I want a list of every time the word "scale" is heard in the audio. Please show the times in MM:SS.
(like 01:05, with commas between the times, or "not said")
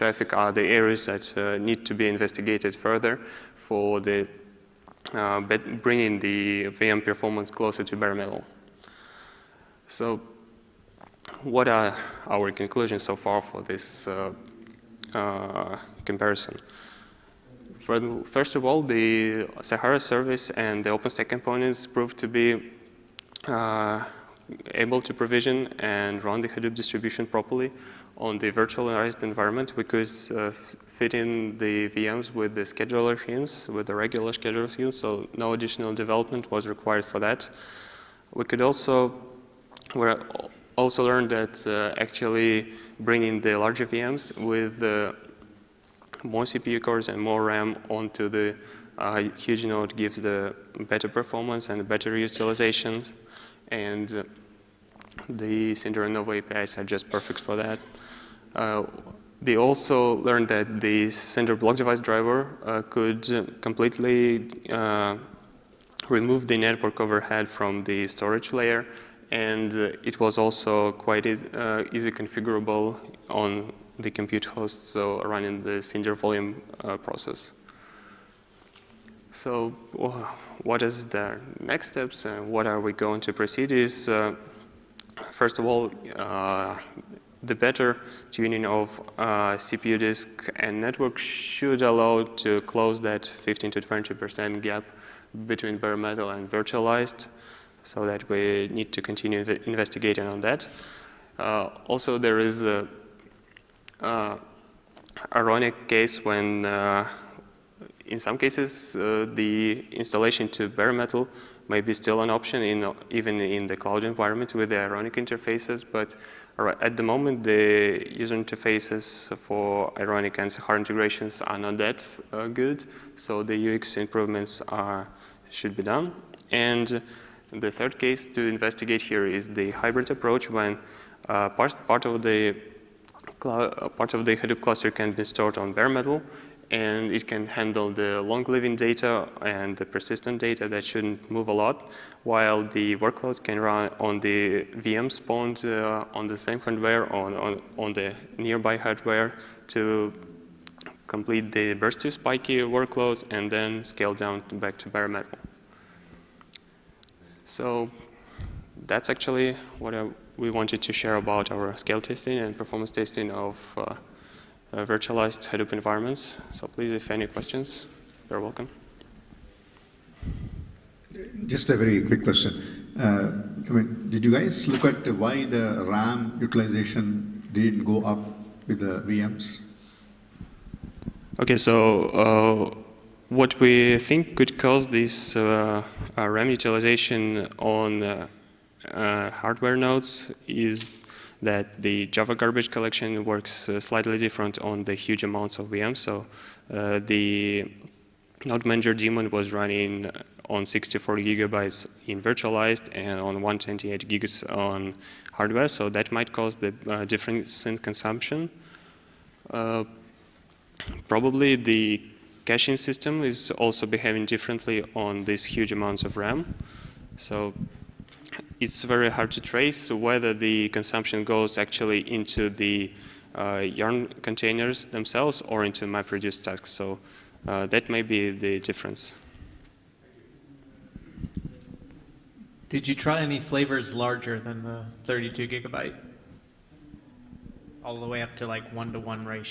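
02:33, 02:41.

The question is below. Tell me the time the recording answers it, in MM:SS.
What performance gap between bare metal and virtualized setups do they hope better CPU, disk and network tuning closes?
01:33.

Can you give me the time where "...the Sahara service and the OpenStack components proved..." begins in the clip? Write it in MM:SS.
00:18.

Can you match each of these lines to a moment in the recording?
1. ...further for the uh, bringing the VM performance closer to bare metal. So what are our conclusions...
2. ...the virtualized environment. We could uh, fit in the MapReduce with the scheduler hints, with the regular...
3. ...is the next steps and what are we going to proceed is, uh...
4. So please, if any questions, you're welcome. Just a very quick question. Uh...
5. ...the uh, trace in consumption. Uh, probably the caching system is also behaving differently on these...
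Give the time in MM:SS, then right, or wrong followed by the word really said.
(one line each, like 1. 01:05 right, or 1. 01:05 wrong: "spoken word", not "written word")
1. 00:02 right
2. 00:28 wrong: "VMs", not "MapReduce"
3. 01:20 right
4. 02:46 right
5. 03:26 wrong: "difference", not "trace".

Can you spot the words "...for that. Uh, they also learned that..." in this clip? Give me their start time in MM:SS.
00:57.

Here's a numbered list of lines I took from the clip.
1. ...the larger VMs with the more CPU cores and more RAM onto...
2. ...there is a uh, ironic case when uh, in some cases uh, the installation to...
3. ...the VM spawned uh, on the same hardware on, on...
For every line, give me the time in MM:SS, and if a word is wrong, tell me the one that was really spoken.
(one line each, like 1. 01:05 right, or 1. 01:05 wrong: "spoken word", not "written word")
1. 00:43 right
2. 01:42 right
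3. 02:24 right.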